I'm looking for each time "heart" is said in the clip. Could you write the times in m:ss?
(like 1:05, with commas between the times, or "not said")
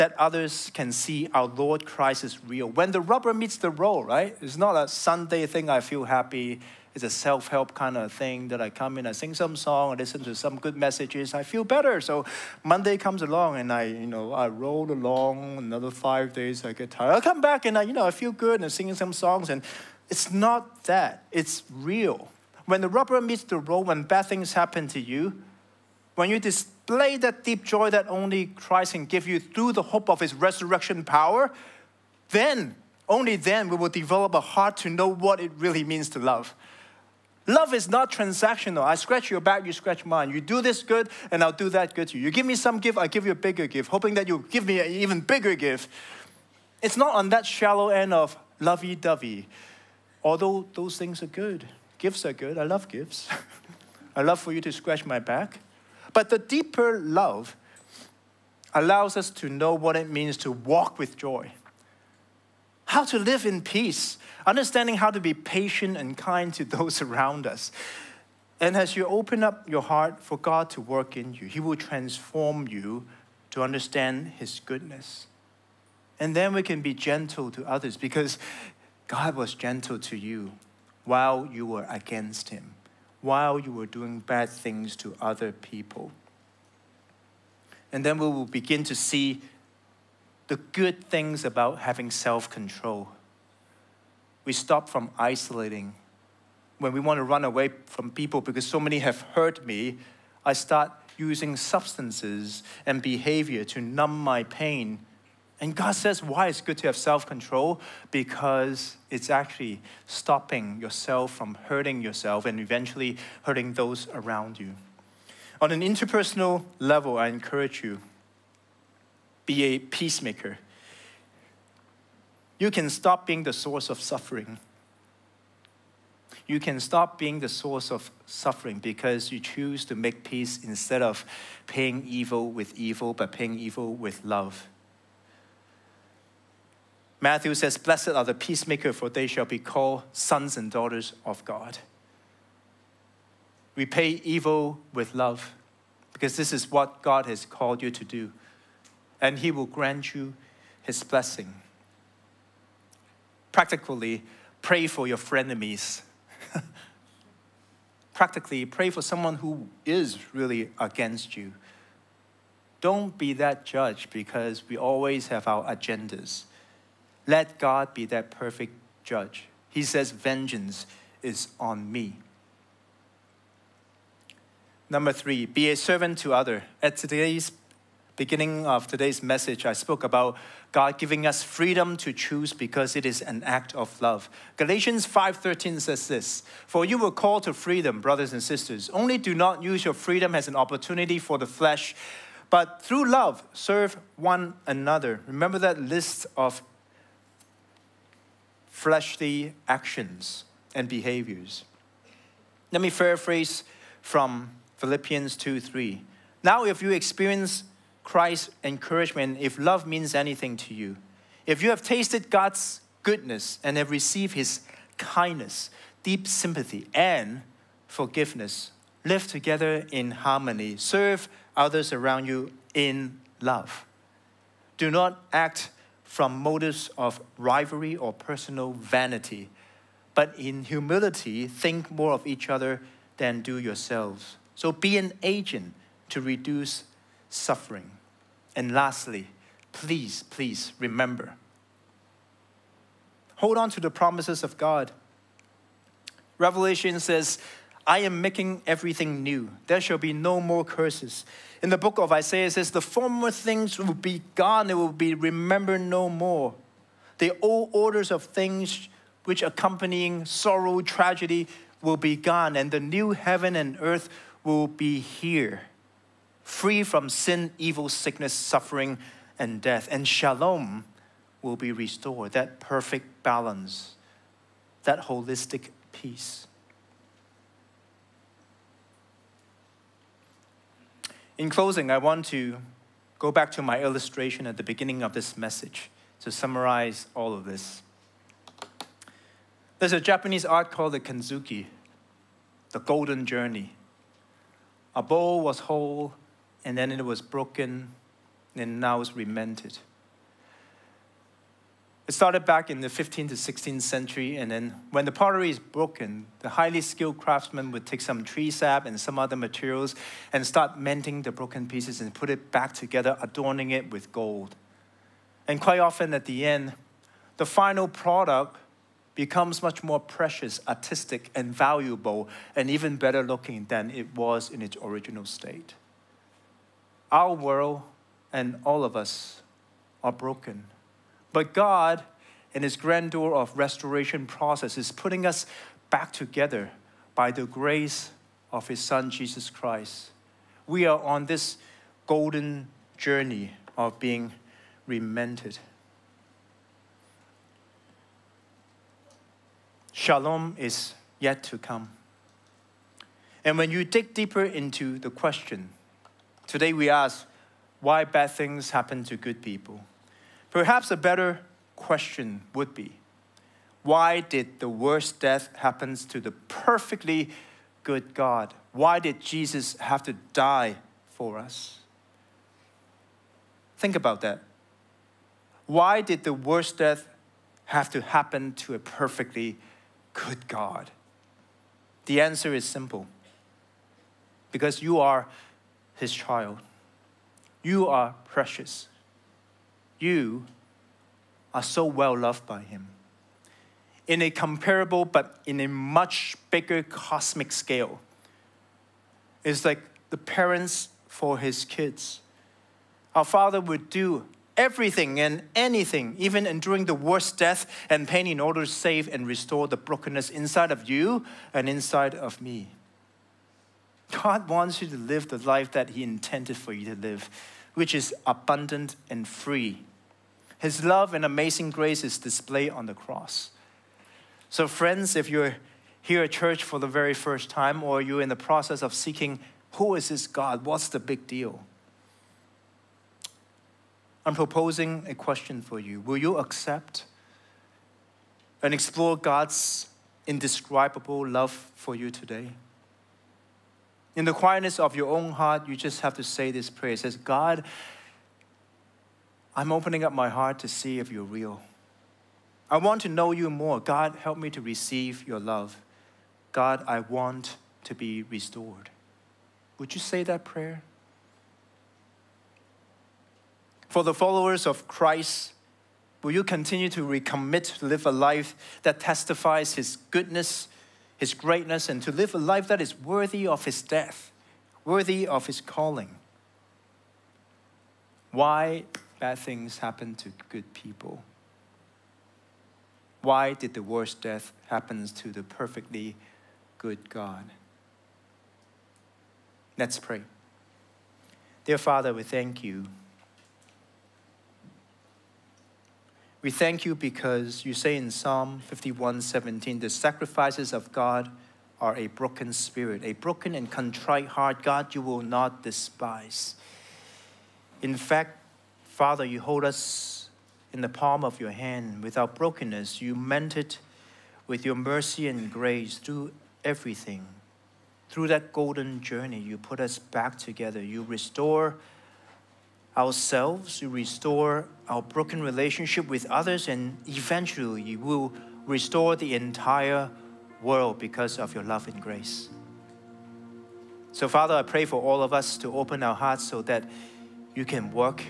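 0:34, 1:09, 7:25, 7:30, 8:24, 8:56.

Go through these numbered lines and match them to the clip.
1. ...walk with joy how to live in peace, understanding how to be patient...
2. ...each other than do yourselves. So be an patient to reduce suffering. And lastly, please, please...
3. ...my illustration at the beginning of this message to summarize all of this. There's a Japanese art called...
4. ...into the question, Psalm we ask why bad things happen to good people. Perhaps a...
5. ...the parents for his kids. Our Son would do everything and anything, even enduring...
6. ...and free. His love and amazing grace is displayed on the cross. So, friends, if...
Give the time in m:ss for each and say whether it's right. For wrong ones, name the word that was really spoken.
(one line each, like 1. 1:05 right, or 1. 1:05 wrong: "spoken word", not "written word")
1. 1:00 right
2. 3:52 wrong: "agent", not "patient"
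3. 4:43 right
4. 5:54 wrong: "Today", not "Psalm"
5. 6:40 wrong: "Father", not "Son"
6. 6:59 right.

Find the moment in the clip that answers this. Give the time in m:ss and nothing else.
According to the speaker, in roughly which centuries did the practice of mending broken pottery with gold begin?
5:02.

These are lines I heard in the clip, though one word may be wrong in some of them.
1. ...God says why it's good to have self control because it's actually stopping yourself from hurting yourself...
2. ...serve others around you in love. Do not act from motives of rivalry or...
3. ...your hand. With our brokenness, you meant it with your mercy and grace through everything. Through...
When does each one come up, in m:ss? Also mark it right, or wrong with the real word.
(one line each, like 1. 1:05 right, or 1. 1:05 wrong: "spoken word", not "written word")
1. 1:45 right
2. 3:40 right
3. 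8:31 right.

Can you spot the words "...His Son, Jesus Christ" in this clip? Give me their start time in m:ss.
5:38.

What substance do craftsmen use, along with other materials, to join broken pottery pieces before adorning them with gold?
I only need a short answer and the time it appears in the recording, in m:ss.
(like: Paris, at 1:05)
tree sap, at 5:08.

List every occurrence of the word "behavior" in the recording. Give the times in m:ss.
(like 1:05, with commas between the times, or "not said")
1:42, 3:20.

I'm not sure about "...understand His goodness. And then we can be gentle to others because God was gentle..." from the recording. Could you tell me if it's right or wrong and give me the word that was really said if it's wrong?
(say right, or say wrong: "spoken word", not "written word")
right.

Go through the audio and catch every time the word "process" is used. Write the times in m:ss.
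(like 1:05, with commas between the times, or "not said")
5:34, 7:08.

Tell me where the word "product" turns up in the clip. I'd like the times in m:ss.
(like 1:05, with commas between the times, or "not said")
5:17.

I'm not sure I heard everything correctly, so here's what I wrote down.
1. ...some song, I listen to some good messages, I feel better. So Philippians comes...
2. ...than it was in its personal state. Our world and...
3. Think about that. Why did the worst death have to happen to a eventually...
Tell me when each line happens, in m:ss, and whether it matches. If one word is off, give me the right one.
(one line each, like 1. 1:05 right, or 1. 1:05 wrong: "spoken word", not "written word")
1. 0:09 wrong: "Monday", not "Philippians"
2. 5:23 wrong: "original", not "personal"
3. 6:13 wrong: "perfectly", not "eventually".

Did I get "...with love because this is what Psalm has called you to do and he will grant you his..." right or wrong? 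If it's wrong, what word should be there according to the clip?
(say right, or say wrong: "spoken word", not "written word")
wrong: "God", not "Psalm".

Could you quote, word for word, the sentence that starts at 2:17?
Matthew says, Blessed are the peacemaker, for they shall be called sons and daughters of God.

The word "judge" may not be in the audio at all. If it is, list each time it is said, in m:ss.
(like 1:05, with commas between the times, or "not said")
2:43, 2:49.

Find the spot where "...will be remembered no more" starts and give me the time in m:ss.
4:14.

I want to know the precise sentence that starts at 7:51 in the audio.
his greatness, and to live a life that is worthy of his death, worthy of his calling.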